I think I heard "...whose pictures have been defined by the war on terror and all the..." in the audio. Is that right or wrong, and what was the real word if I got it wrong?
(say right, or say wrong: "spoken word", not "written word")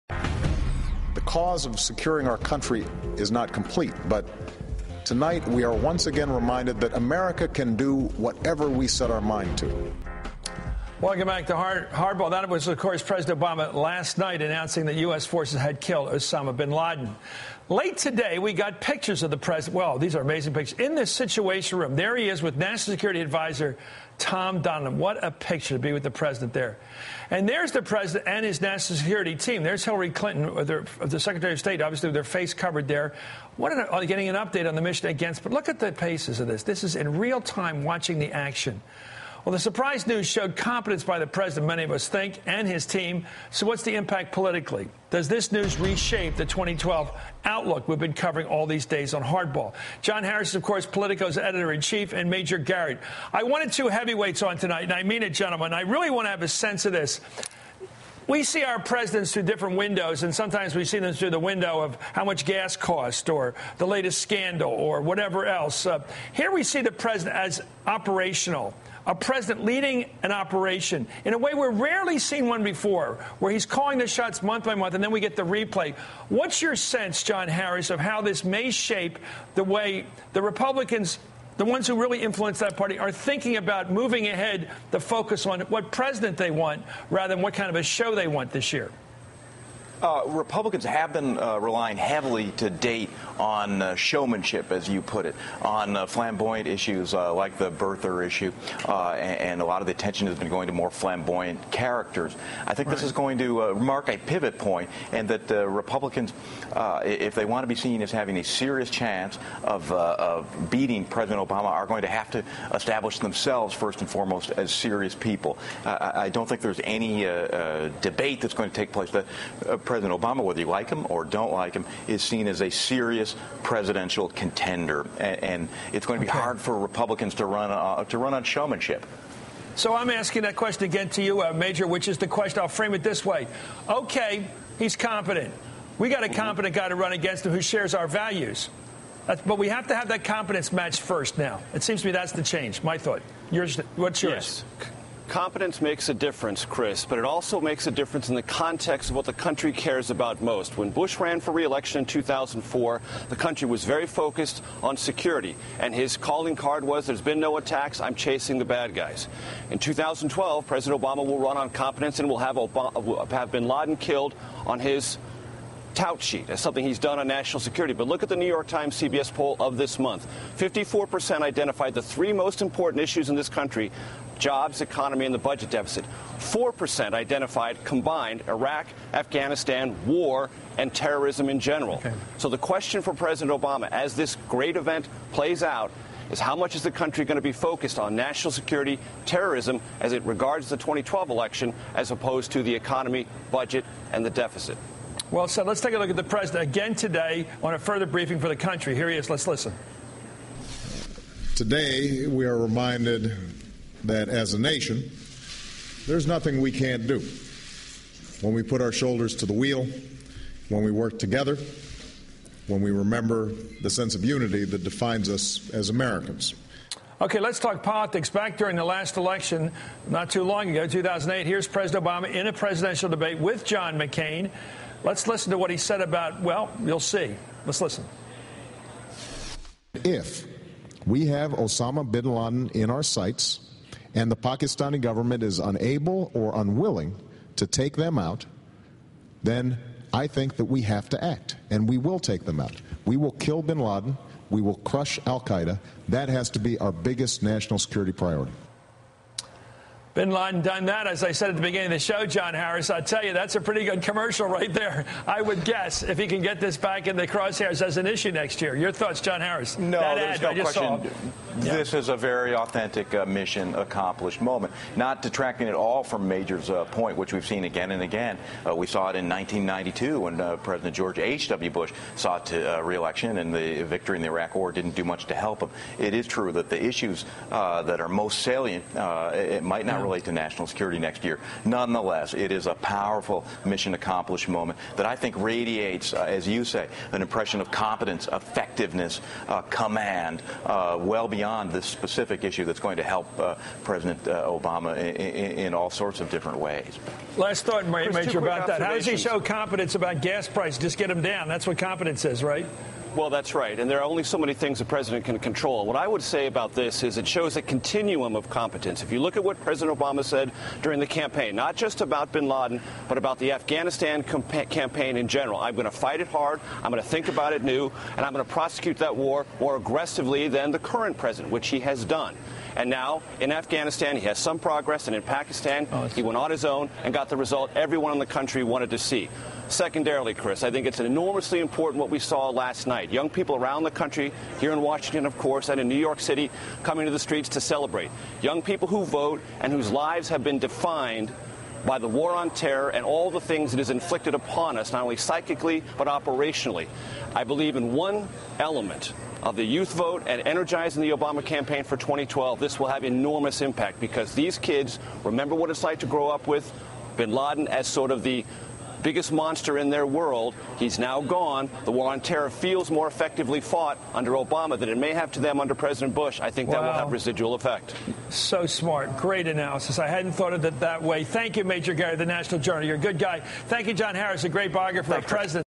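wrong: "lives", not "pictures".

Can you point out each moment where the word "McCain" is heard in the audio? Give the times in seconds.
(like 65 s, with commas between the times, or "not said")
223 s.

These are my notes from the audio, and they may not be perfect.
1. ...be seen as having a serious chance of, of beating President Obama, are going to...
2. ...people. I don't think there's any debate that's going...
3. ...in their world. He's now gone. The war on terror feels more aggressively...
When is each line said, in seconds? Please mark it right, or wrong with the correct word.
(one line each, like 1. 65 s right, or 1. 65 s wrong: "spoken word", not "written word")
1. 107 s right
2. 115 s right
3. 359 s wrong: "effectively", not "aggressively".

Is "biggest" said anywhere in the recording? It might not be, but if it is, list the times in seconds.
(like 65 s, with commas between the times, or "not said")
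246 s, 359 s.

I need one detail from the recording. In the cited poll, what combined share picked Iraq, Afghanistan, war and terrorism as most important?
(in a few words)
4%.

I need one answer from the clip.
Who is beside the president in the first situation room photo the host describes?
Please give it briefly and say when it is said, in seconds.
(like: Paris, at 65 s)
Tom Donilon, at 24 s.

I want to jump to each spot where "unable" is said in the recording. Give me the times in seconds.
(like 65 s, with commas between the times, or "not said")
235 s.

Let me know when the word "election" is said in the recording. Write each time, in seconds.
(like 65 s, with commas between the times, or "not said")
151 s, 191 s, 219 s, 272 s.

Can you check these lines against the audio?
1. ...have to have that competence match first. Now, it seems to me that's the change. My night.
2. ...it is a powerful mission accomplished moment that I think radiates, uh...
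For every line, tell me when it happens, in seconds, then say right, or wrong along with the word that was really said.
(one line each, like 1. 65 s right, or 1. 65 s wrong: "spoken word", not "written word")
1. 139 s wrong: "thought", not "night"
2. 282 s right.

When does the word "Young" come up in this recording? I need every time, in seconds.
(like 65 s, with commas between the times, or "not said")
333 s, 338 s.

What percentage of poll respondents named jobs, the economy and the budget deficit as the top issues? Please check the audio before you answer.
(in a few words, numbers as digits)
54%.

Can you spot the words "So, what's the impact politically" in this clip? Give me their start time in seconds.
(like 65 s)
43 s.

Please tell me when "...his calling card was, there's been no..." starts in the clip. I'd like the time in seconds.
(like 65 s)
155 s.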